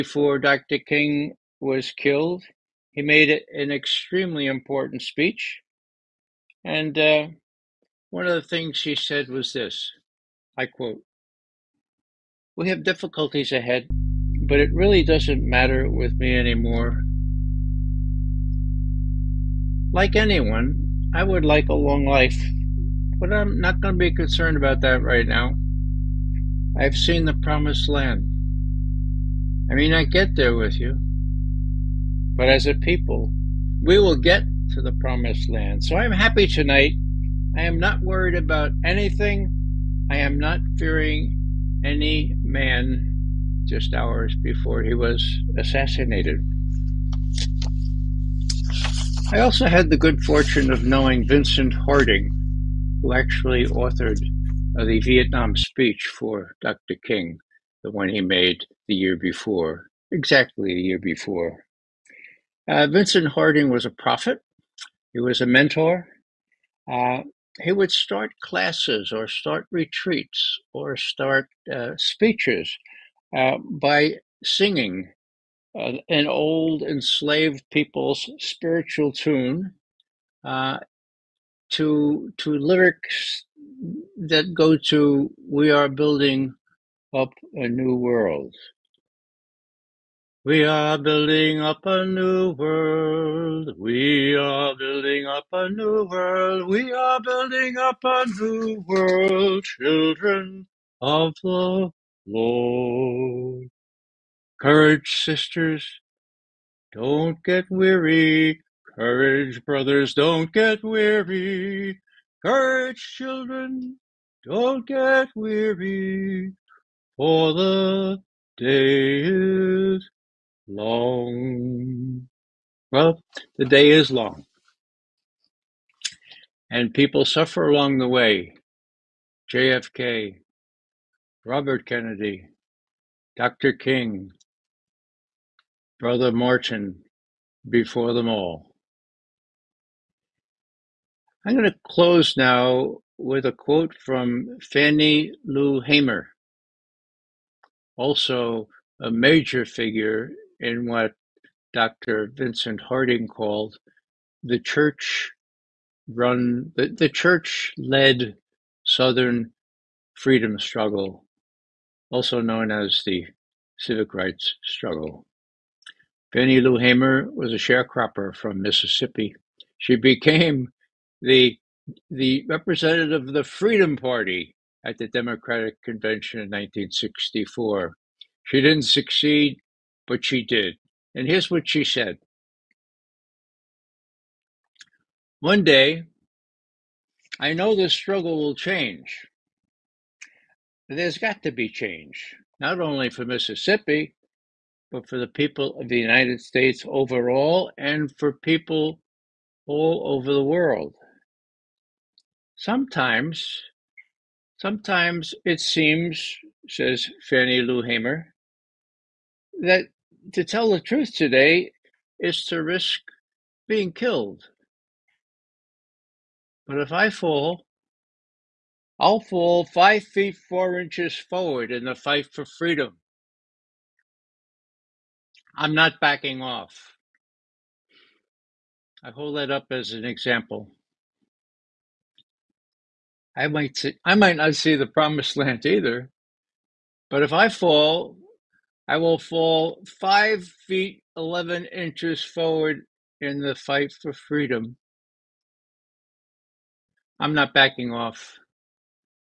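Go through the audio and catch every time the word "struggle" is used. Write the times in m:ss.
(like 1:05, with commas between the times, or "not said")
2:40, 2:44, 3:07.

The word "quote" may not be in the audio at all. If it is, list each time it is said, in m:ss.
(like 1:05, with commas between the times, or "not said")
0:10, 2:23.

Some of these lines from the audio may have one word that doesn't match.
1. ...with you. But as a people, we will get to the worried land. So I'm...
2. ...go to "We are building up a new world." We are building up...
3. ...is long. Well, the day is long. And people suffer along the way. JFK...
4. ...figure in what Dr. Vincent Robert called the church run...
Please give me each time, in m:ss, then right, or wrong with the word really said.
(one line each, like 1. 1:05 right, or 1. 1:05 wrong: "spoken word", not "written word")
1. 0:30 wrong: "promised", not "worried"
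2. 1:24 right
3. 1:59 right
4. 2:29 wrong: "Harding", not "Robert".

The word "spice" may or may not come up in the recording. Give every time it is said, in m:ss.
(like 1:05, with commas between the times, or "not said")
not said.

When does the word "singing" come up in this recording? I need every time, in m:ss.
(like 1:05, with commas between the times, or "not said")
1:14.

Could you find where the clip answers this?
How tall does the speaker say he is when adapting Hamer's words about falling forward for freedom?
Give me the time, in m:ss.
3:59.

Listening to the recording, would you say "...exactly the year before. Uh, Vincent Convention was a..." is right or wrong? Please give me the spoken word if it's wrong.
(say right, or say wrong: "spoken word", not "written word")
wrong: "Harding", not "Convention".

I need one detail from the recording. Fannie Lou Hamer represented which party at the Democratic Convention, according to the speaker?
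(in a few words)
Freedom Party.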